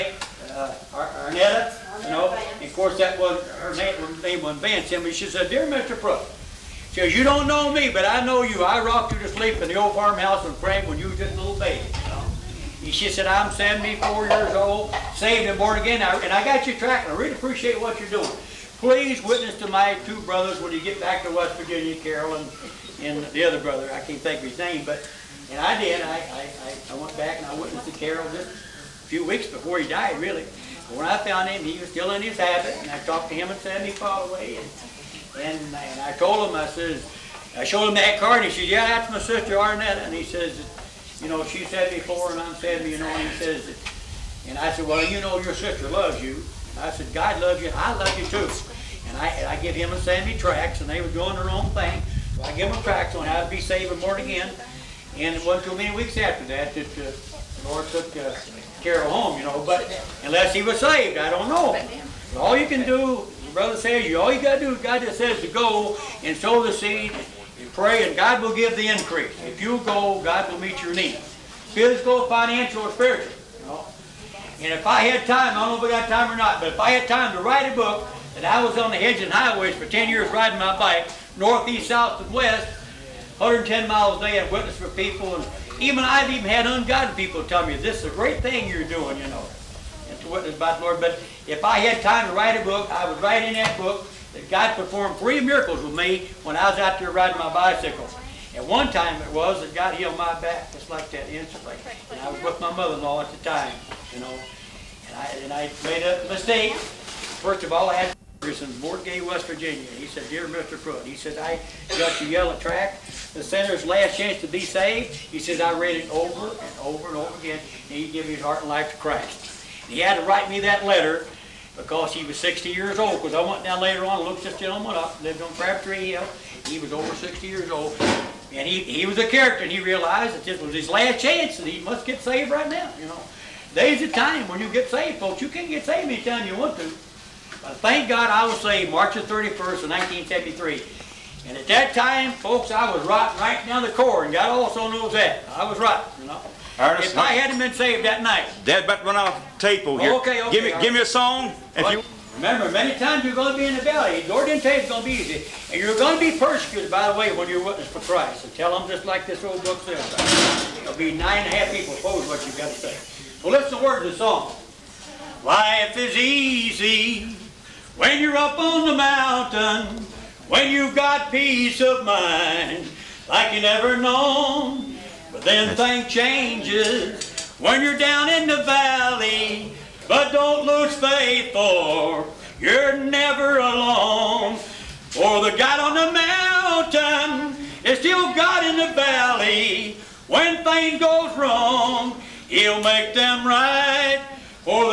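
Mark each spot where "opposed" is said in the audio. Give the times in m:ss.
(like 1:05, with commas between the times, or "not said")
2:41.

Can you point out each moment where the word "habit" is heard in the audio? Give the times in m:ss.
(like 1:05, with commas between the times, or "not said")
0:32.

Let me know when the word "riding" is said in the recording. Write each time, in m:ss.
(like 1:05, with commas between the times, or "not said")
1:20, 1:37.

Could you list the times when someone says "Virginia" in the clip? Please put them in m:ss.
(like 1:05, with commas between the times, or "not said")
0:21, 1:49.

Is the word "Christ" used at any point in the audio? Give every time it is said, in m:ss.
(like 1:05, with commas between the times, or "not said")
1:58, 2:37.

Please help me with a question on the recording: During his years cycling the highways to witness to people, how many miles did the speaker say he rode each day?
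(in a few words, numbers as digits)
110.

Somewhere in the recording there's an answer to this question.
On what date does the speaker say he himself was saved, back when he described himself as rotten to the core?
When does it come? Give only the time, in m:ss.
2:18.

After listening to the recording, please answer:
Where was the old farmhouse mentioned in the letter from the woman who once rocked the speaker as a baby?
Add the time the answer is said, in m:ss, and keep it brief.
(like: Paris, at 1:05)
Frank, at 0:10.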